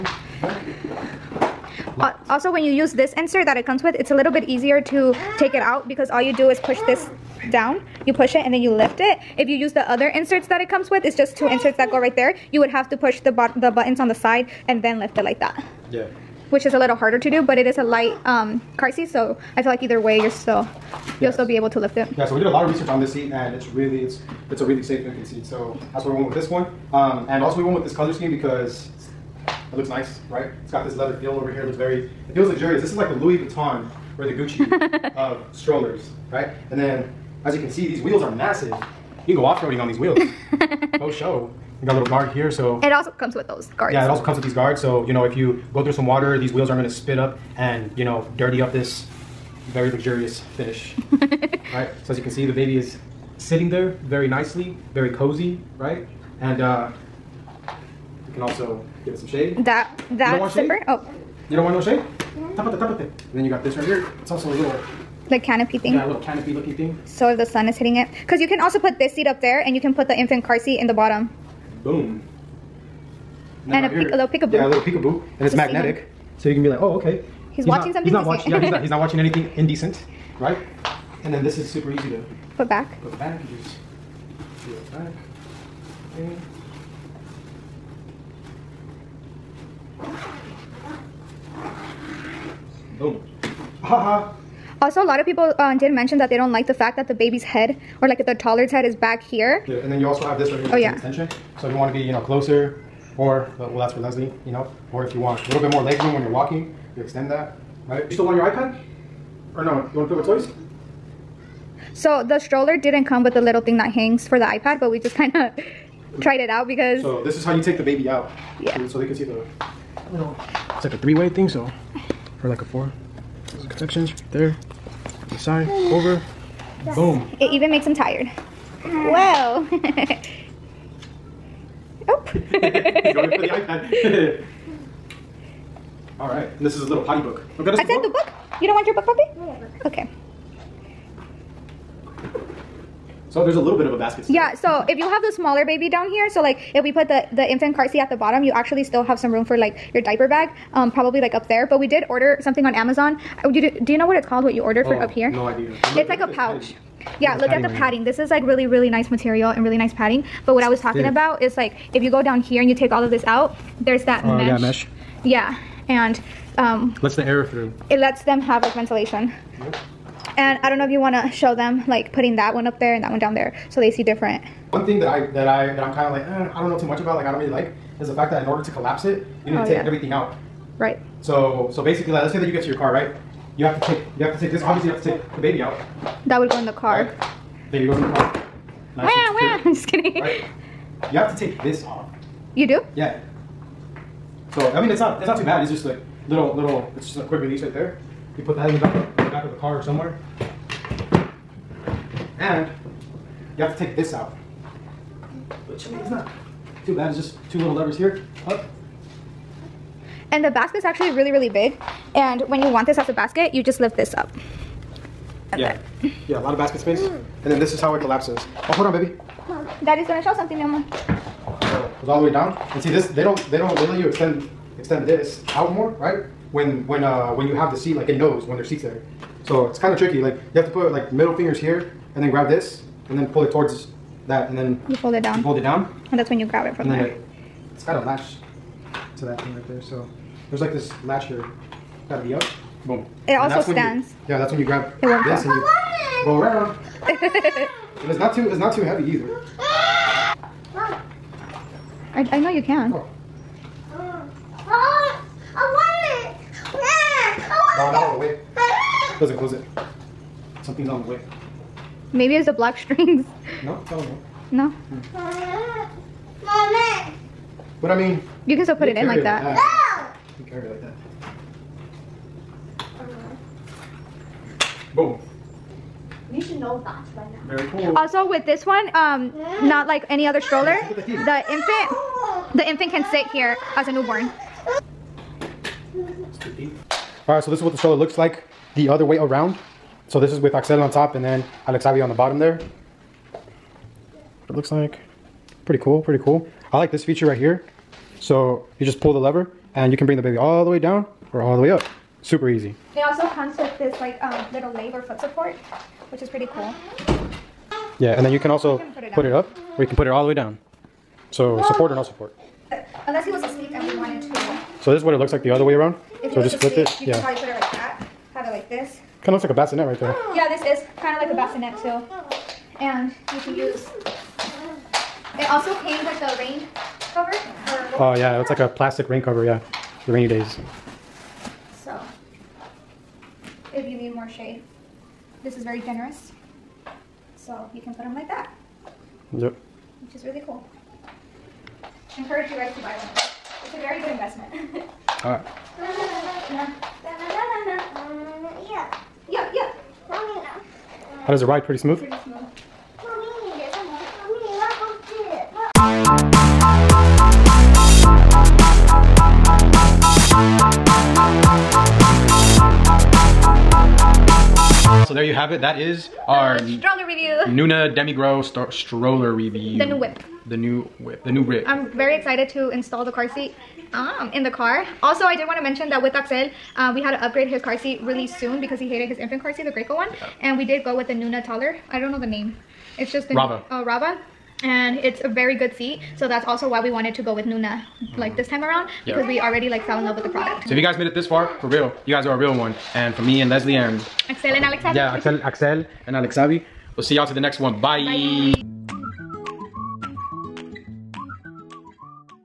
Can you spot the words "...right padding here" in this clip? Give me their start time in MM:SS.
02:37.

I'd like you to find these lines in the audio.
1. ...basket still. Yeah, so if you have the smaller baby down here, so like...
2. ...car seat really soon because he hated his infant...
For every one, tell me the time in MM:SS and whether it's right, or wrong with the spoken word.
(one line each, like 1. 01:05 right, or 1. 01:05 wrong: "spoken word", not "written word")
1. 02:23 right
2. 06:17 right.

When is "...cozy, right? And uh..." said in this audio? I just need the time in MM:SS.
00:55.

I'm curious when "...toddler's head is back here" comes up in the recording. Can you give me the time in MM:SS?
01:38.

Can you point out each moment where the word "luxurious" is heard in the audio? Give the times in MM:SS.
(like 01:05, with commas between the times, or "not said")
00:32, 00:49.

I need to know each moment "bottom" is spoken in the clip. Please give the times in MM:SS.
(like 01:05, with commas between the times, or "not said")
01:10, 02:28, 04:52.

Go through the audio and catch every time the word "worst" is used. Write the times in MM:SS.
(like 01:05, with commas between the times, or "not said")
not said.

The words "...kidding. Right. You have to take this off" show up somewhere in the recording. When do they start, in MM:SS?
03:09.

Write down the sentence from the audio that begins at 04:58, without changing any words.
So you just pull the lever and you can bring the baby all the way down or all the way up.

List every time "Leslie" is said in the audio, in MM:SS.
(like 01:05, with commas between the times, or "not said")
01:43, 06:33.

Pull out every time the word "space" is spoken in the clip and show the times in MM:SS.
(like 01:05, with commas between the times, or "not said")
03:36.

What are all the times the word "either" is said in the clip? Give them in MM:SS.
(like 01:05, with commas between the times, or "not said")
00:19, 04:09.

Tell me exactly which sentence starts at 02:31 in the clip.
But we did order something on Amazon.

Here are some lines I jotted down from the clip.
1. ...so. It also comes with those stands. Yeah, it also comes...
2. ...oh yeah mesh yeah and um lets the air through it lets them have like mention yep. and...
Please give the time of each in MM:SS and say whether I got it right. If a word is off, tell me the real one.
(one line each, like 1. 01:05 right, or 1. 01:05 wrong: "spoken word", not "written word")
1. 00:42 wrong: "guards", not "stands"
2. 02:44 wrong: "ventilation", not "mention".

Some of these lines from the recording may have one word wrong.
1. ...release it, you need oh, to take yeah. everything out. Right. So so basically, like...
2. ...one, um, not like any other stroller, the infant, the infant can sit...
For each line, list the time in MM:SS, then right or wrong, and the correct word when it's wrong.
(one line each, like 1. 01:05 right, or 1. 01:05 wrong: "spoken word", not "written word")
1. 02:58 wrong: "collapse", not "release"
2. 04:38 right.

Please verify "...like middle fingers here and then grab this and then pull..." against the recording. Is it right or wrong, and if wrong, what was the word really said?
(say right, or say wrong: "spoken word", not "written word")
right.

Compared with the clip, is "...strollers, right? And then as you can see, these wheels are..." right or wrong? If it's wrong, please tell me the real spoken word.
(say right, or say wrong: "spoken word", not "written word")
right.